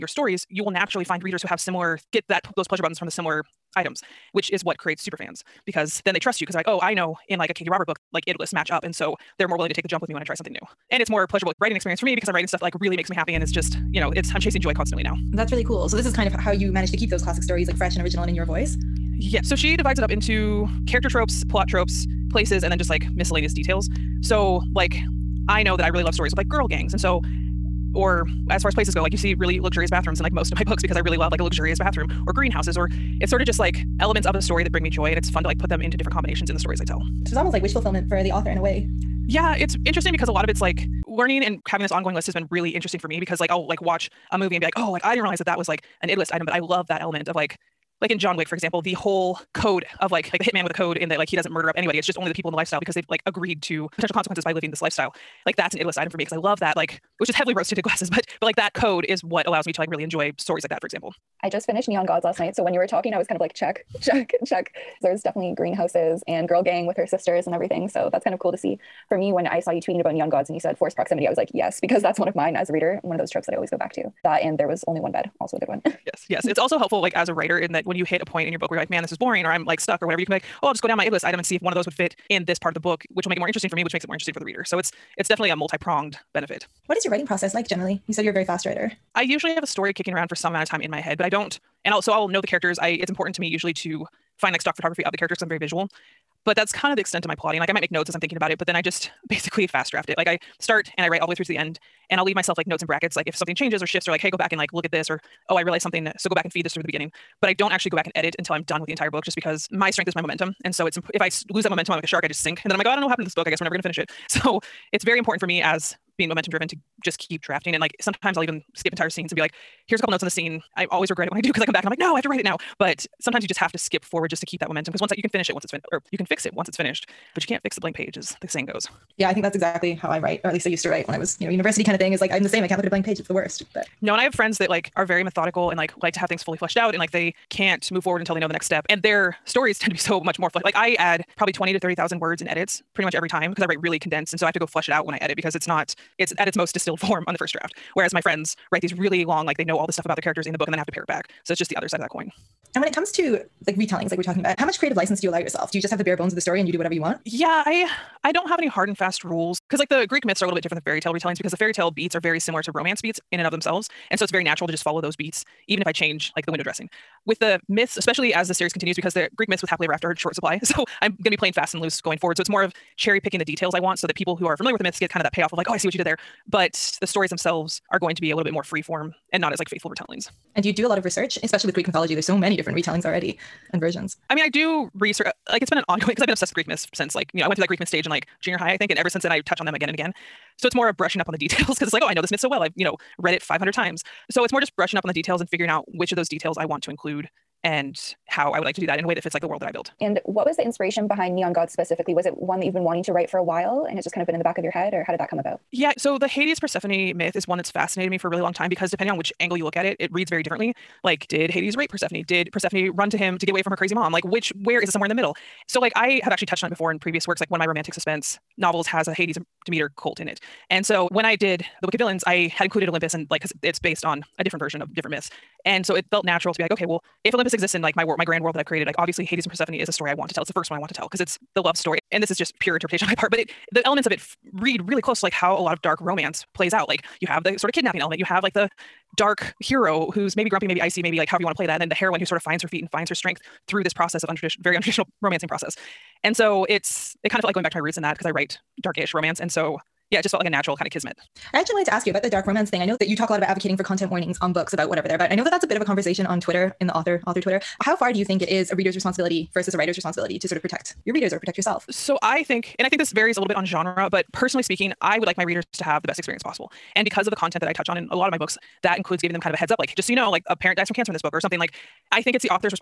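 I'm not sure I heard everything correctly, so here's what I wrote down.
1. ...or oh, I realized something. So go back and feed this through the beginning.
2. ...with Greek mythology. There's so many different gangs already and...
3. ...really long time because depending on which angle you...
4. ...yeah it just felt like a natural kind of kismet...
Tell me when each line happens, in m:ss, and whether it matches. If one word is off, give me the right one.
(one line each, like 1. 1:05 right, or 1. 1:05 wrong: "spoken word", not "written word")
1. 1:45 right
2. 3:01 wrong: "retellings", not "gangs"
3. 3:28 right
4. 4:10 right.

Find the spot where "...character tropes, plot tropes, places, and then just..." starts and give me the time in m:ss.
0:20.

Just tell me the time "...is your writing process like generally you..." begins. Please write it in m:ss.
1:26.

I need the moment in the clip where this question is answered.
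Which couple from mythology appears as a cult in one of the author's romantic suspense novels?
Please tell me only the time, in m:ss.
3:39.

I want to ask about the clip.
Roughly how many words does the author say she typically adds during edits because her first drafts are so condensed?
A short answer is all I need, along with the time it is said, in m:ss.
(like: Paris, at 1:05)
20,000 to 30,000, at 2:21.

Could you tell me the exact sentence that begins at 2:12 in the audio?
I can't look at a blank page.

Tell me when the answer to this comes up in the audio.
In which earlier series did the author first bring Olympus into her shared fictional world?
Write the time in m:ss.
3:41.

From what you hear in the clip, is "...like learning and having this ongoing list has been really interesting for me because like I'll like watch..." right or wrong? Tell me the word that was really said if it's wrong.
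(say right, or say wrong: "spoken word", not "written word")
right.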